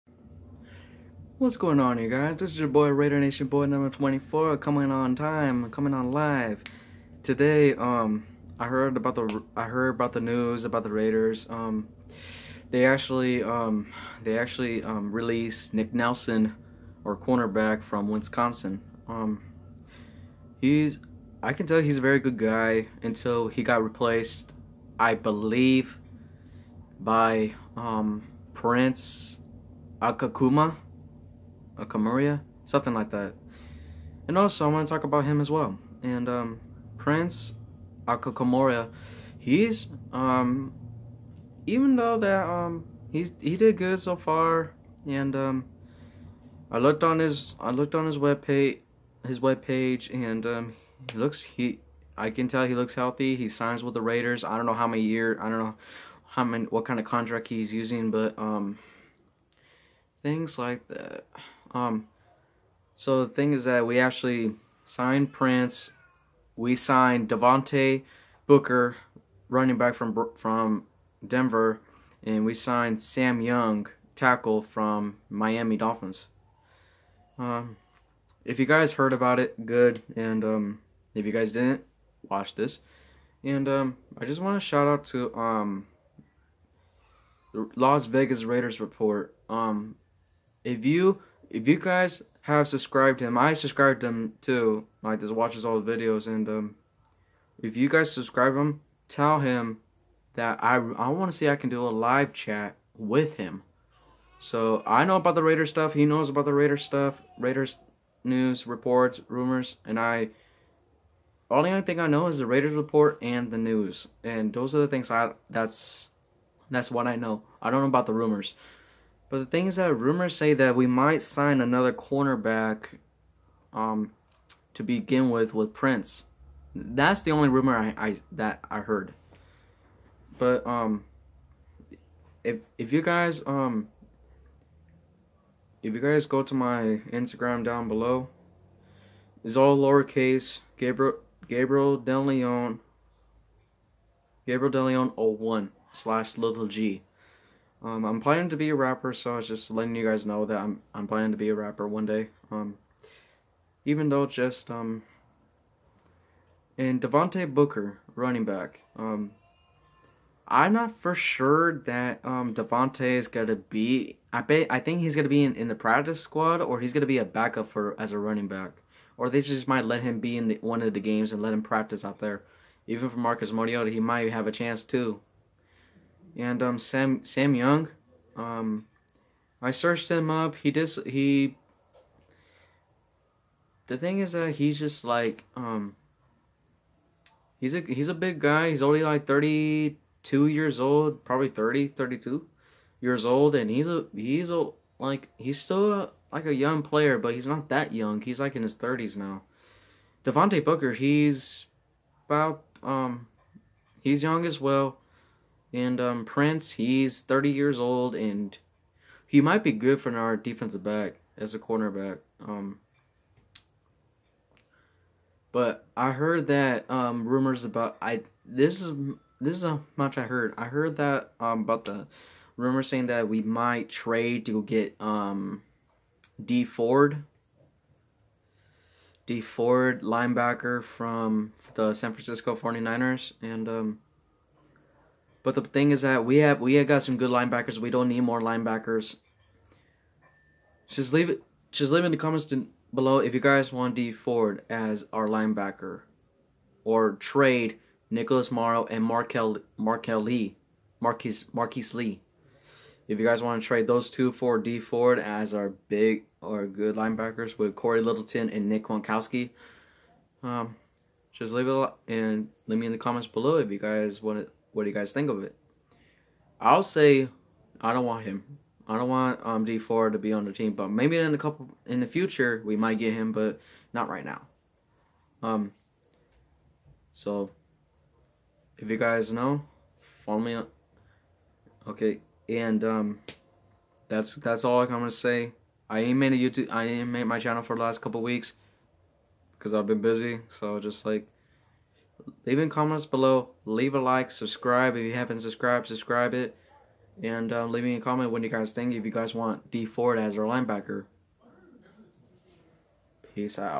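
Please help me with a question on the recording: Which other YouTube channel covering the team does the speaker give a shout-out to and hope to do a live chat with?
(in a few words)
Las Vegas Raiders report.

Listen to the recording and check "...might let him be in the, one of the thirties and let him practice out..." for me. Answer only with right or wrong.
wrong.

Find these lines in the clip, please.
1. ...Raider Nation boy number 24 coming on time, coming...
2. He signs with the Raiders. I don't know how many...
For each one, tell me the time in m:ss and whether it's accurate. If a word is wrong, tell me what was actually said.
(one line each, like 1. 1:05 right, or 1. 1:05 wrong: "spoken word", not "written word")
1. 0:02 right
2. 0:53 right.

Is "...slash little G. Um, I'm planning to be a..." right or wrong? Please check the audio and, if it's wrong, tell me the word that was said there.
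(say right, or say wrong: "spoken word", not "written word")
right.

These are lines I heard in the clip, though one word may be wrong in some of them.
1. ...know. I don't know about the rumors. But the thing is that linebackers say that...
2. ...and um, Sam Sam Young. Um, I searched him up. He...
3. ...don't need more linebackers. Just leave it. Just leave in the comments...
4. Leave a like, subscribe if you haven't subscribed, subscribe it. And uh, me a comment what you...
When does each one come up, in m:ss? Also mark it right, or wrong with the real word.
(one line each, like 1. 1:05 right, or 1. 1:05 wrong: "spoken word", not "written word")
1. 1:57 wrong: "rumors", not "linebackers"
2. 2:56 right
3. 3:57 right
4. 4:53 right.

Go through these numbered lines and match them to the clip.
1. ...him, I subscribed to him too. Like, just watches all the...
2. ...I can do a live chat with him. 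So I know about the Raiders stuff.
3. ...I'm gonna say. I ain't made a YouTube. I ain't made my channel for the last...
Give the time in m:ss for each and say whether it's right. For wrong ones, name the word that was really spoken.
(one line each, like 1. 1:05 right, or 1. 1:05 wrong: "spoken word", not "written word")
1. 1:33 right
2. 1:41 right
3. 4:44 right.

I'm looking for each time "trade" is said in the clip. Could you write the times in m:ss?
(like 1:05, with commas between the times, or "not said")
3:43, 4:07, 4:13.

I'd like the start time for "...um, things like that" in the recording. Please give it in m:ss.
0:58.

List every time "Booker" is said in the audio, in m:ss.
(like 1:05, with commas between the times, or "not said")
1:08, 2:37, 3:20.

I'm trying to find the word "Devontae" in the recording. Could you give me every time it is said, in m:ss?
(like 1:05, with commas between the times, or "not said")
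1:07, 2:37, 2:42, 3:20.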